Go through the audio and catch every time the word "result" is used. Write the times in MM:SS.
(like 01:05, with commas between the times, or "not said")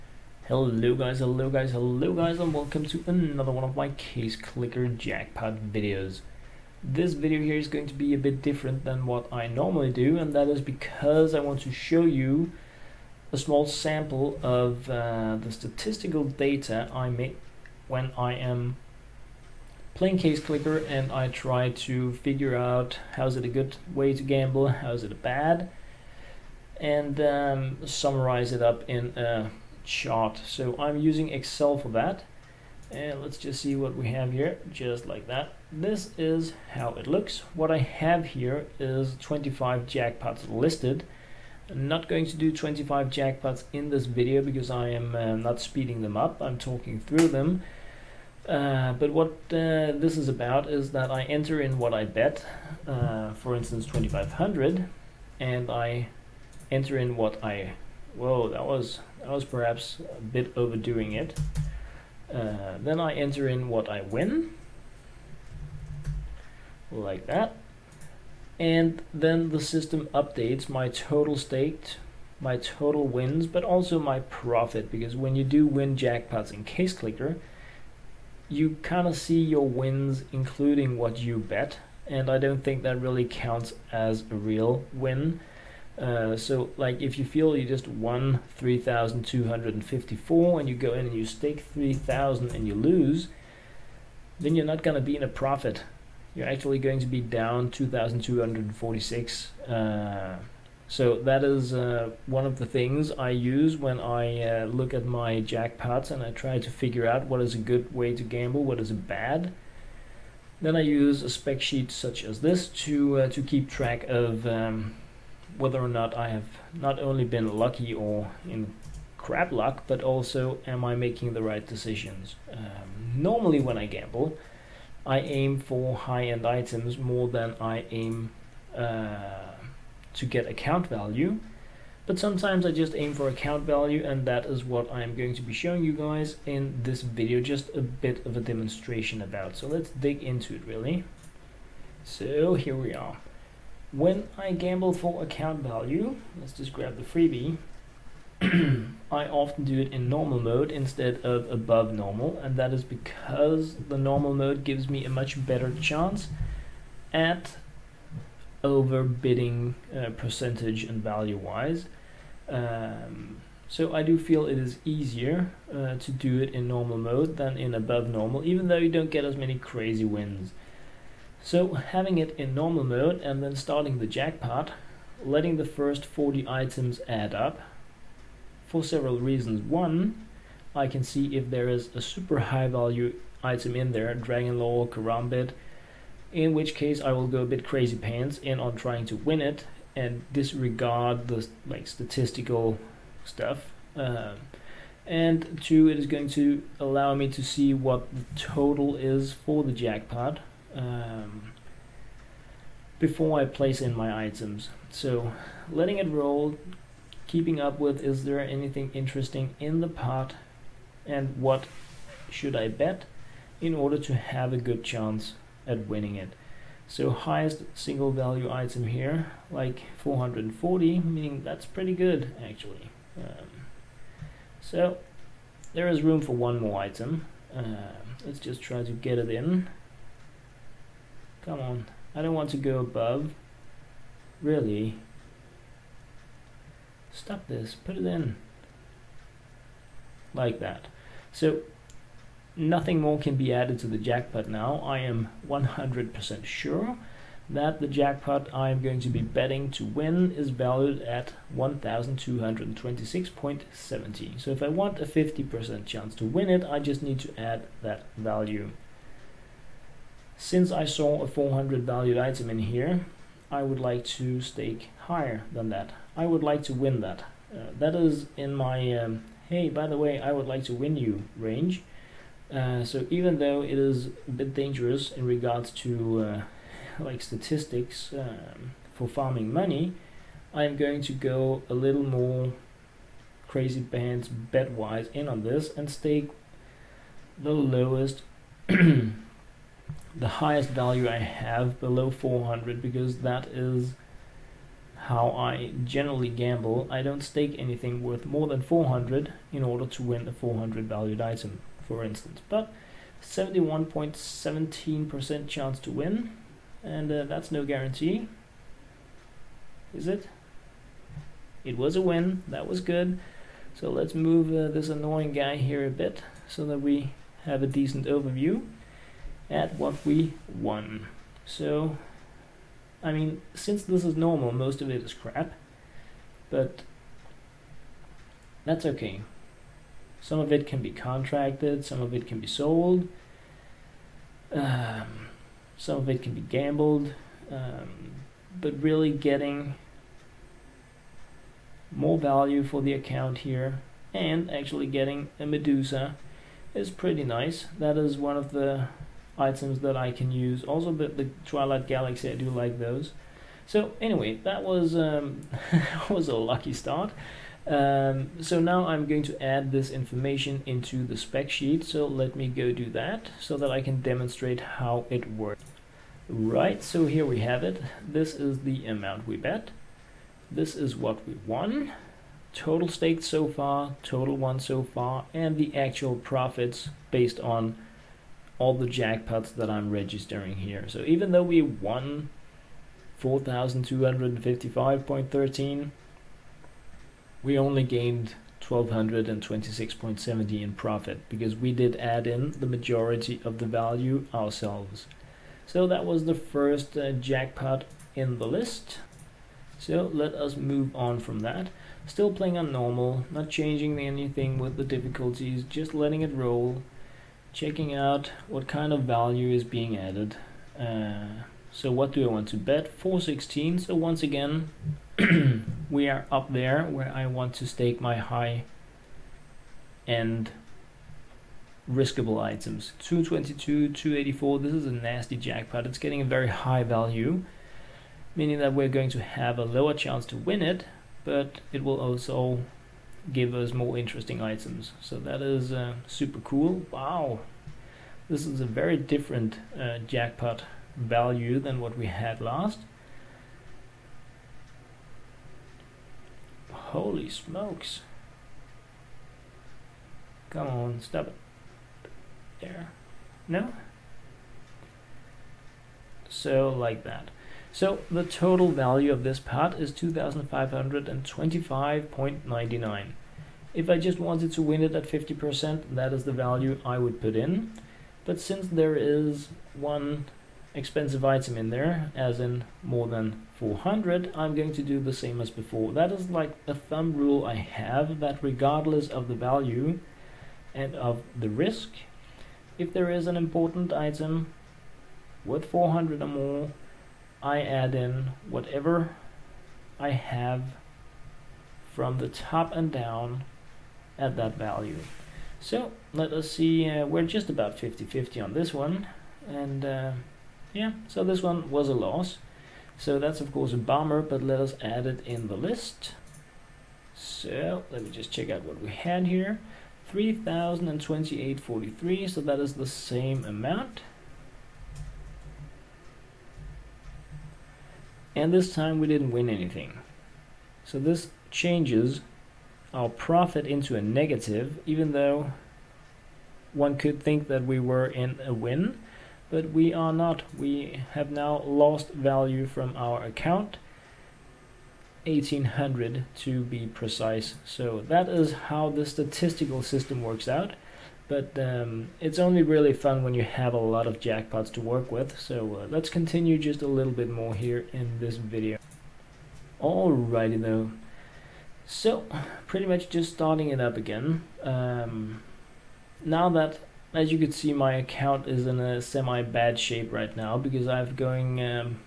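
not said.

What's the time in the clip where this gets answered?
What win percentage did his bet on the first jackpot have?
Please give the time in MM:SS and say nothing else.
05:03.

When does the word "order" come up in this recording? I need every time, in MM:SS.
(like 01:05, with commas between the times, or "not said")
03:33, 04:59.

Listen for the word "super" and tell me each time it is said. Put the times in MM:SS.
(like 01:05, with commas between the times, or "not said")
03:02, 07:16.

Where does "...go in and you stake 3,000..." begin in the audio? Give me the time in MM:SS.
01:30.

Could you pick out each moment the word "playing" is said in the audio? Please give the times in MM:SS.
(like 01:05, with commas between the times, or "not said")
00:19, 06:42.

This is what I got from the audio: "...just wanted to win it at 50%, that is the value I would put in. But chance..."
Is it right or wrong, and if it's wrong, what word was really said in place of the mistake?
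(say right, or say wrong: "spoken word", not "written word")
wrong: "since", not "chance".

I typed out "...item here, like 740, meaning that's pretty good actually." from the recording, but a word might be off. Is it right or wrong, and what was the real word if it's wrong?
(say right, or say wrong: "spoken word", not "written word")
wrong: "440", not "740".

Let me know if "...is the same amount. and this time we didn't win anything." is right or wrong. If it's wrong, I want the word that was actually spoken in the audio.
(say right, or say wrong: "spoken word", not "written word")
right.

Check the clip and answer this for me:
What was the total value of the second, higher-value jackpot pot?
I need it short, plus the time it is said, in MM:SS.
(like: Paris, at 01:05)
2525.99, at 07:39.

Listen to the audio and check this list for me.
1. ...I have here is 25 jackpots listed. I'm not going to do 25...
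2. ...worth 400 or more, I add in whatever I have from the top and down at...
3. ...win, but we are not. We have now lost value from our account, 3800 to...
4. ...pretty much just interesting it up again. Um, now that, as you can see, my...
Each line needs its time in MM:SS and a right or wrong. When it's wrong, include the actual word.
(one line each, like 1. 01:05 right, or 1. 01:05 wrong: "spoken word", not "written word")
1. 00:37 right
2. 08:05 right
3. 08:48 wrong: "1800", not "3800"
4. 09:12 wrong: "starting", not "interesting".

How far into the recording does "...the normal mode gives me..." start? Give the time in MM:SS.
02:33.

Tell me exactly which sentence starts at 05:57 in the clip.
Um, so now I'm going to add this information into the spec sheet.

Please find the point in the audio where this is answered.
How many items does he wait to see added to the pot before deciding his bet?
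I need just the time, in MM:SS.
02:56.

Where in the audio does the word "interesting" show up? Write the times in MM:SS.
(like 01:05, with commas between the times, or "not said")
03:28, 07:13.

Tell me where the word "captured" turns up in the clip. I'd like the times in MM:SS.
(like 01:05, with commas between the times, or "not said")
not said.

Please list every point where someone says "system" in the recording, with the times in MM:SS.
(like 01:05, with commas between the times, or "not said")
01:09, 08:59.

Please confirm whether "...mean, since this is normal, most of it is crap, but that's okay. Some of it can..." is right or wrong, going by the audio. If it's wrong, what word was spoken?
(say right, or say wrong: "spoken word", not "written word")
right.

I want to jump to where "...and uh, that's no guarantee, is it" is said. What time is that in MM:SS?
05:06.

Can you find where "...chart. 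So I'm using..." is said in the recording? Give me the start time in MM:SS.
00:29.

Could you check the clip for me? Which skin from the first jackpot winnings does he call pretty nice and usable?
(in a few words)
Medusa.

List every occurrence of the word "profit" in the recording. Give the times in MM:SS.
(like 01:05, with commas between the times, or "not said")
01:14, 01:35, 06:16, 06:30, 08:43.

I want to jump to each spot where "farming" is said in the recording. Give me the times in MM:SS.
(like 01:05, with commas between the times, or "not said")
04:39.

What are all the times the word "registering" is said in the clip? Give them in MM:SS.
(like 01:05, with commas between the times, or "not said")
06:19.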